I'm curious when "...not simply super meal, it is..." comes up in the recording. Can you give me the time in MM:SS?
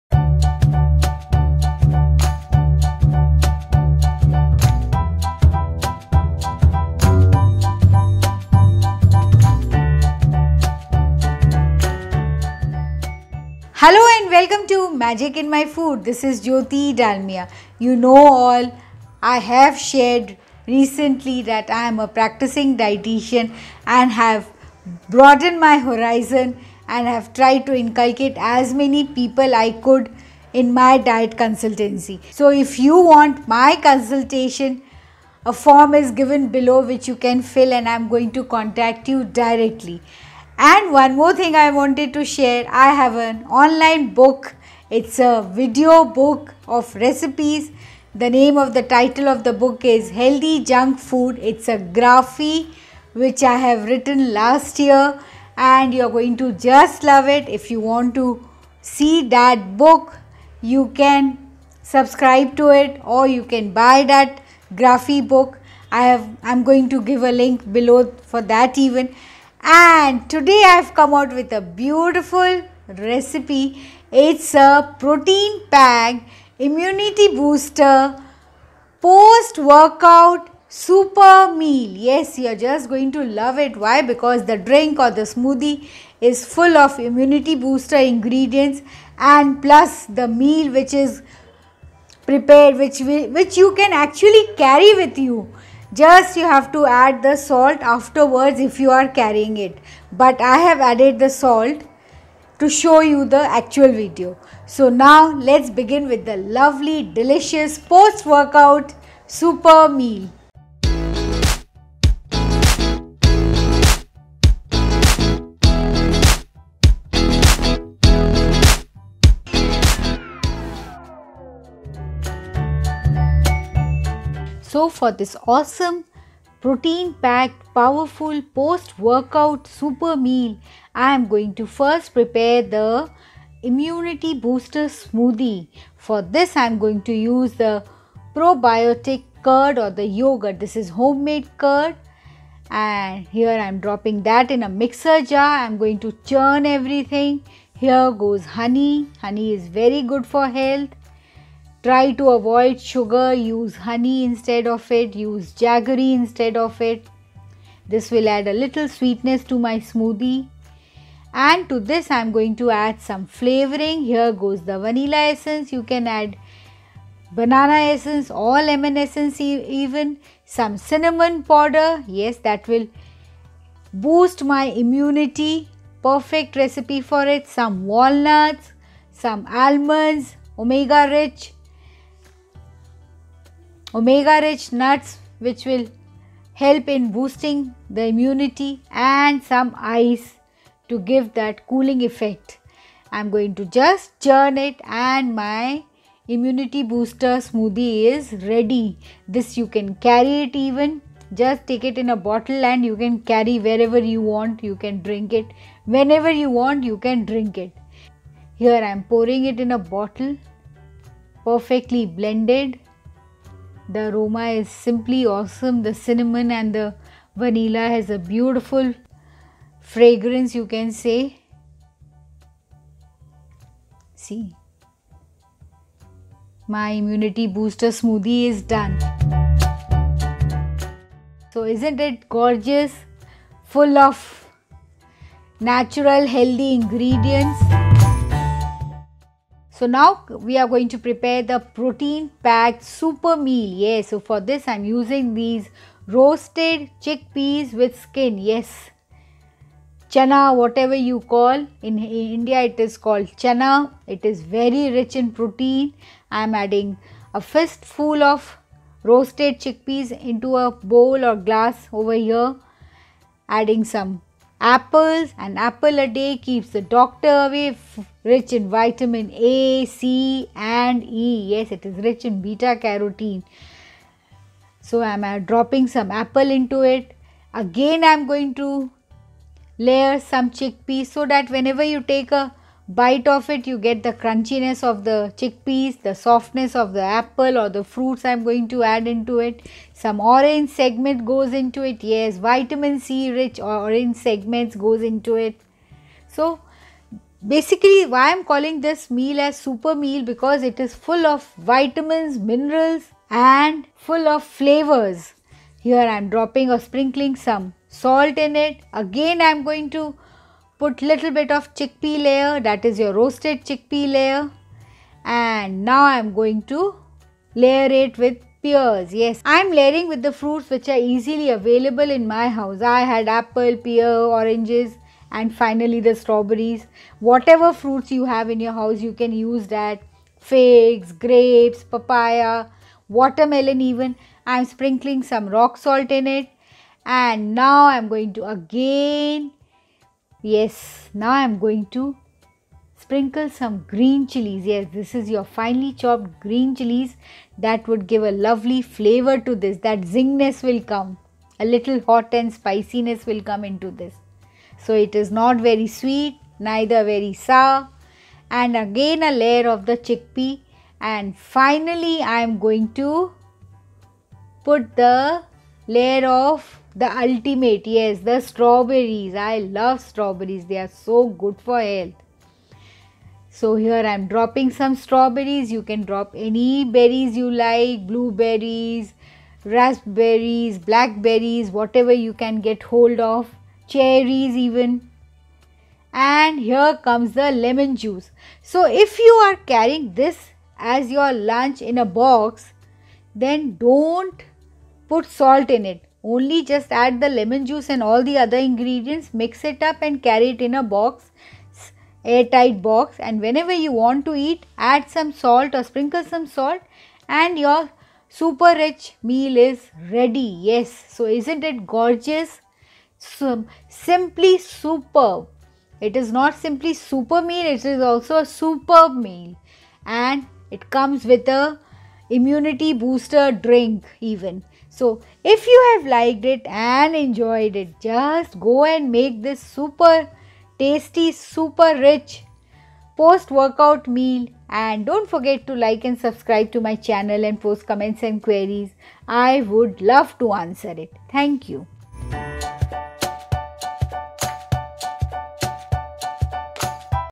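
06:56.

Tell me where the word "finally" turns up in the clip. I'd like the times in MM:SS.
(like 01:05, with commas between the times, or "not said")
05:25, 06:01.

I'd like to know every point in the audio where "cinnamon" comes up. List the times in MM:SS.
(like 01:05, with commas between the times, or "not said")
02:50, 03:35.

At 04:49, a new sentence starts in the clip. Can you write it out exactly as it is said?
Some orange segment goes into it.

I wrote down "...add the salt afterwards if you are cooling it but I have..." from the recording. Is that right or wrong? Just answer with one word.
wrong.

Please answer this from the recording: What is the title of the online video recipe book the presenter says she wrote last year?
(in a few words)
Healthy Junk Food.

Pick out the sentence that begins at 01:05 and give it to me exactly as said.
I have I'm going to give a link below for that even and today I've come out with a beautiful recipe.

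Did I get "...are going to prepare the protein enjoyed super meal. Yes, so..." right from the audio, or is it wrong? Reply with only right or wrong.
wrong.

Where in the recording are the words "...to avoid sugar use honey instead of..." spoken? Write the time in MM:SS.
02:32.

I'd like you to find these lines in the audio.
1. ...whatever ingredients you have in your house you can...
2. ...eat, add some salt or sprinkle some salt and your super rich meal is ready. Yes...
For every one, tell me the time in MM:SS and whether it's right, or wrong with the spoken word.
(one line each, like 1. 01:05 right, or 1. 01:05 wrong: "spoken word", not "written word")
1. 05:27 wrong: "fruits", not "ingredients"
2. 06:44 right.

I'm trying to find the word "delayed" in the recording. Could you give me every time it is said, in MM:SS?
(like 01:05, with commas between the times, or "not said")
not said.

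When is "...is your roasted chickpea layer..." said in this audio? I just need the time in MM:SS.
05:12.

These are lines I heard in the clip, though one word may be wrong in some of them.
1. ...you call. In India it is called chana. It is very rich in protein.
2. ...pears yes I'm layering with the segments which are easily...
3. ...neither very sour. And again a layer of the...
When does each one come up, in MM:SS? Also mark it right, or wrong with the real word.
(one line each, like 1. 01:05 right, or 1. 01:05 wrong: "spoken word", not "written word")
1. 04:10 right
2. 05:18 wrong: "fruits", not "segments"
3. 05:56 right.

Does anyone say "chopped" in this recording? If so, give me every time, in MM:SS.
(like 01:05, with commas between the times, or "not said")
05:45.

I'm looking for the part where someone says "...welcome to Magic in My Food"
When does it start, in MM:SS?
00:14.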